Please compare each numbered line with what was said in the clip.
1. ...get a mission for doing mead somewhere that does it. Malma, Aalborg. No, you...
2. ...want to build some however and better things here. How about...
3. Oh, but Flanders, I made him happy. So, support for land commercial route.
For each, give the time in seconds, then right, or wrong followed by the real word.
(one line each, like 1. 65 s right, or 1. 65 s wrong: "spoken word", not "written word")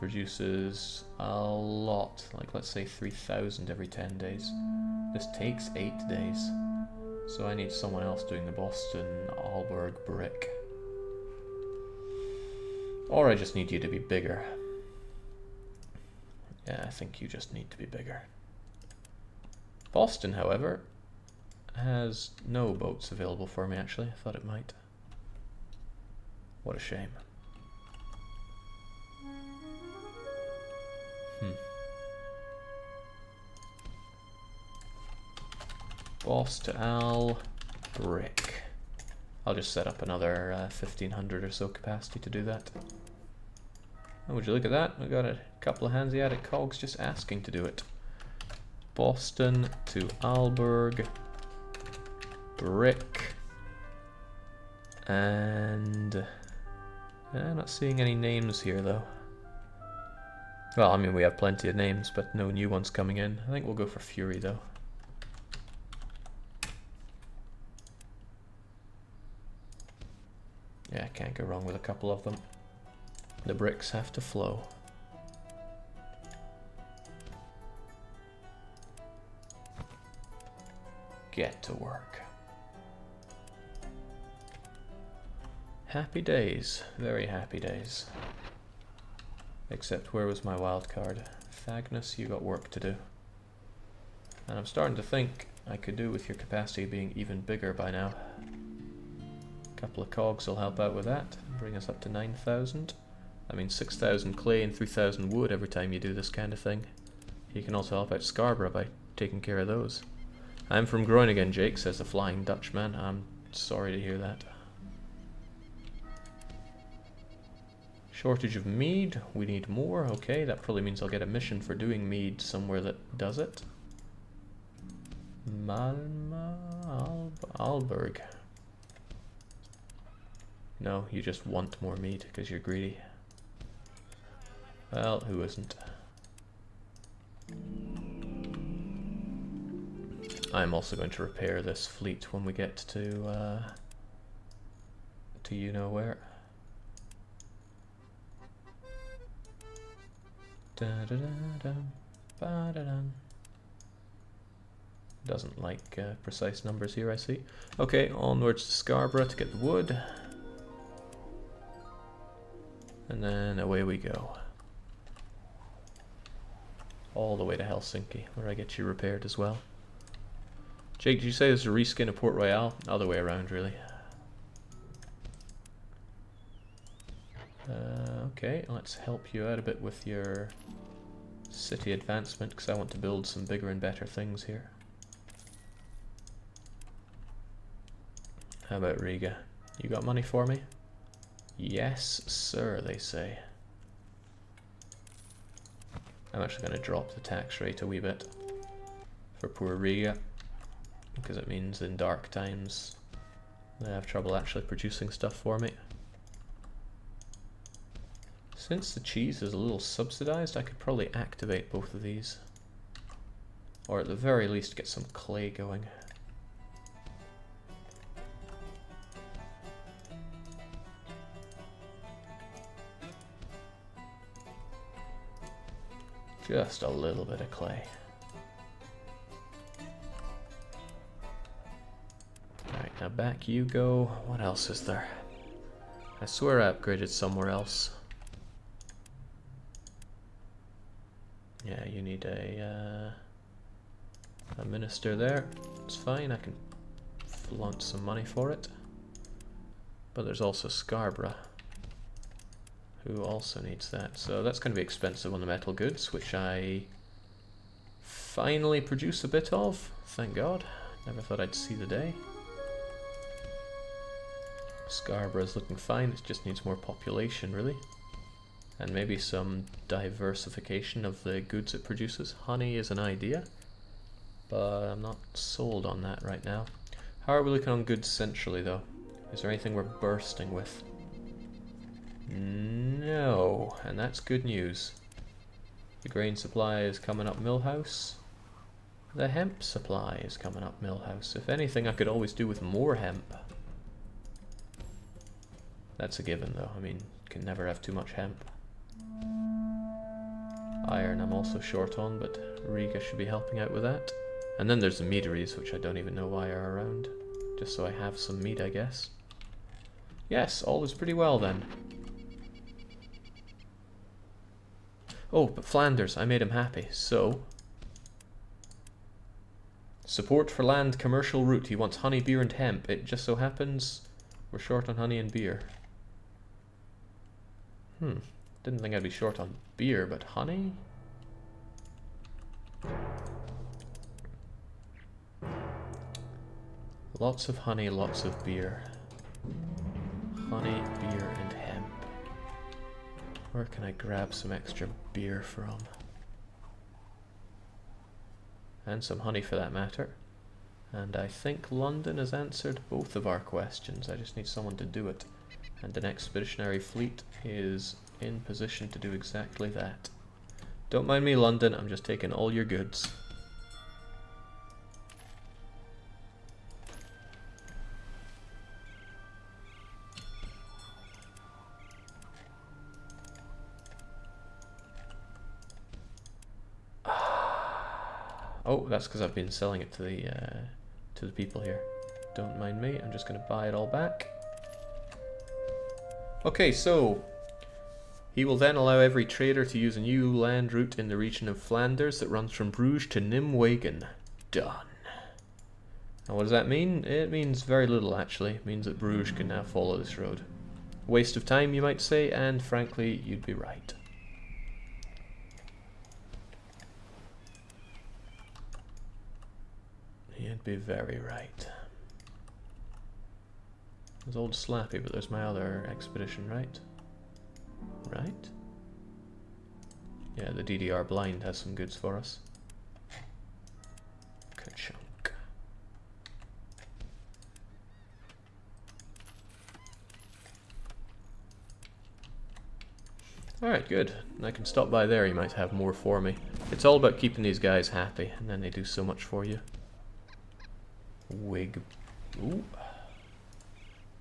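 1. 121 s right
2. 182 s wrong: "bigger", not "however"
3. 315 s right.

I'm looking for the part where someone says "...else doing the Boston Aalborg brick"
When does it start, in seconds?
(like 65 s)
8 s.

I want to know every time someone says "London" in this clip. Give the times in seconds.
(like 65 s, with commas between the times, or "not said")
351 s, 361 s.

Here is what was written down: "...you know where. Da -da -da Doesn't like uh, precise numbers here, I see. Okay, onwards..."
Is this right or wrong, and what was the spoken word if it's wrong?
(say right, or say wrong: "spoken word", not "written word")
right.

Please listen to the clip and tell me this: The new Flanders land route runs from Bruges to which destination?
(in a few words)
Nimwegen.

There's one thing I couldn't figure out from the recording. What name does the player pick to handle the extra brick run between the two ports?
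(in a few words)
Fury.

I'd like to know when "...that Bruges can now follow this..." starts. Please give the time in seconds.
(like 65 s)
398 s.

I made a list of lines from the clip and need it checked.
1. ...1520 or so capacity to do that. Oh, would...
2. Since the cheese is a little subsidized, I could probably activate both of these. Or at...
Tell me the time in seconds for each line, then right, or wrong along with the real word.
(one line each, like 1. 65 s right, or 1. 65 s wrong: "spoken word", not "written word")
1. 40 s wrong: "1500", not "1520"
2. 208 s right.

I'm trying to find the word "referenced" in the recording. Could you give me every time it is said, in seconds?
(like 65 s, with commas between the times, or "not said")
not said.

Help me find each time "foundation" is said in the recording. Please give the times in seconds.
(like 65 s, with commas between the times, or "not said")
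not said.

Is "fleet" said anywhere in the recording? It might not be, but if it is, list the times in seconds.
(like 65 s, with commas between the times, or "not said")
141 s, 356 s.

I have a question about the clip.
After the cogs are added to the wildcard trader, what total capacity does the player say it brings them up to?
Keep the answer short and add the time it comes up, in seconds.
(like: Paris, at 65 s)
9,000, at 102 s.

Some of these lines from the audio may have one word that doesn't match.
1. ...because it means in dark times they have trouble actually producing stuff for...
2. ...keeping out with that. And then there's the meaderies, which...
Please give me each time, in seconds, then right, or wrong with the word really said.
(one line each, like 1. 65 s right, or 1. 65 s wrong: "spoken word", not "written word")
1. 201 s right
2. 303 s wrong: "helping", not "keeping".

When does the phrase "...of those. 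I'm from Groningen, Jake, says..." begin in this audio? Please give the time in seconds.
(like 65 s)
109 s.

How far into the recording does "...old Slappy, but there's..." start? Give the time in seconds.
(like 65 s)
414 s.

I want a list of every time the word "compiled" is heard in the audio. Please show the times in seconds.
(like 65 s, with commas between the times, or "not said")
not said.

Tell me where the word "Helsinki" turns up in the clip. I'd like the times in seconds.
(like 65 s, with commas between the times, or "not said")
167 s.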